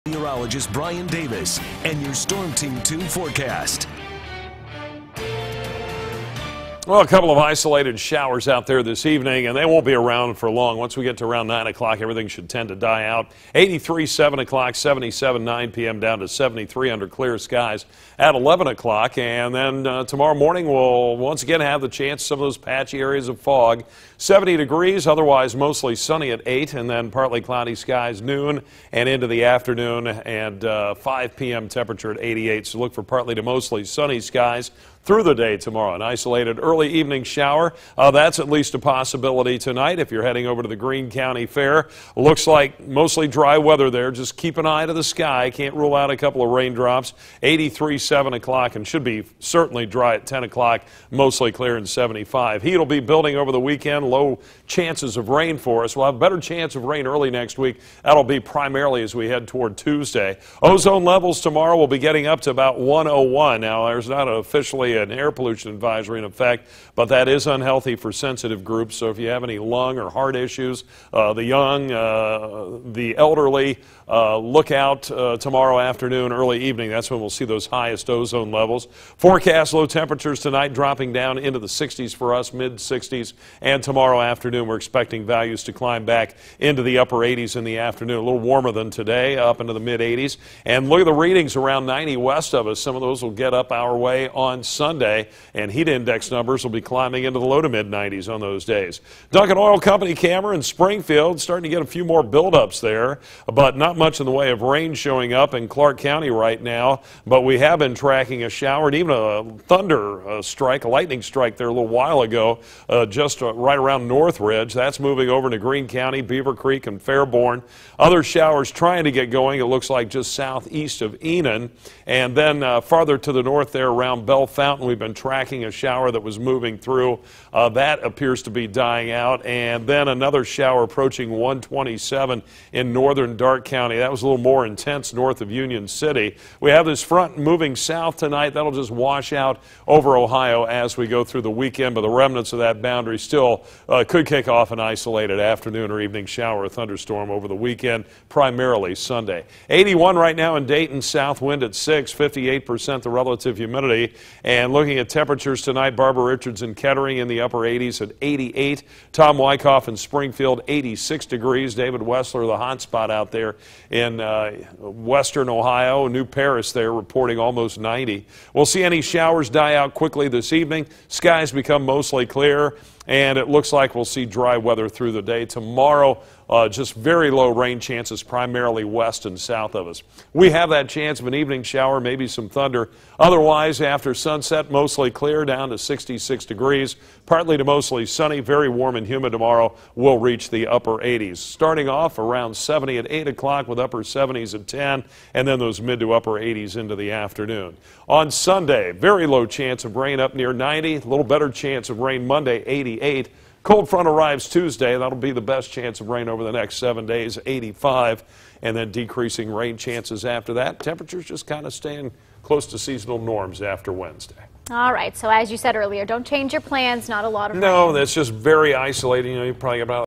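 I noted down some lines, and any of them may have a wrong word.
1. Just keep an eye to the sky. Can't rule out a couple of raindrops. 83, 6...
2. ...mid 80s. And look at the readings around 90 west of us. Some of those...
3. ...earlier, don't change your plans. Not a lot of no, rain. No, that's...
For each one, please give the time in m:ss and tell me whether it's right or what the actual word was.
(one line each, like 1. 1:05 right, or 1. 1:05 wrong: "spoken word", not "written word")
1. 0:44 wrong: "7", not "6"
2. 1:29 right
3. 3:35 right.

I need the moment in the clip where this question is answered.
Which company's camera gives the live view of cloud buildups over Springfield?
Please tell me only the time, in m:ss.
1:39.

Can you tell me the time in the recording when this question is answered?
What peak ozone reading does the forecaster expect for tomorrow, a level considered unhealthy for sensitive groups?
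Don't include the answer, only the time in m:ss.
1:02.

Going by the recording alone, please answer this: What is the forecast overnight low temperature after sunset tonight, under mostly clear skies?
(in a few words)
66 degrees.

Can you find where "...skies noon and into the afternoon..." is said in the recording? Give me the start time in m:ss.
0:27.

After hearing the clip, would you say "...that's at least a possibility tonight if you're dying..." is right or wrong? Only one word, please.
wrong.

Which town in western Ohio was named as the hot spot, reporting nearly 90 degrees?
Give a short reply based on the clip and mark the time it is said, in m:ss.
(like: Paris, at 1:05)
New Paris, at 2:46.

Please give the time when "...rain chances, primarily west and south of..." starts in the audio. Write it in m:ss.
2:57.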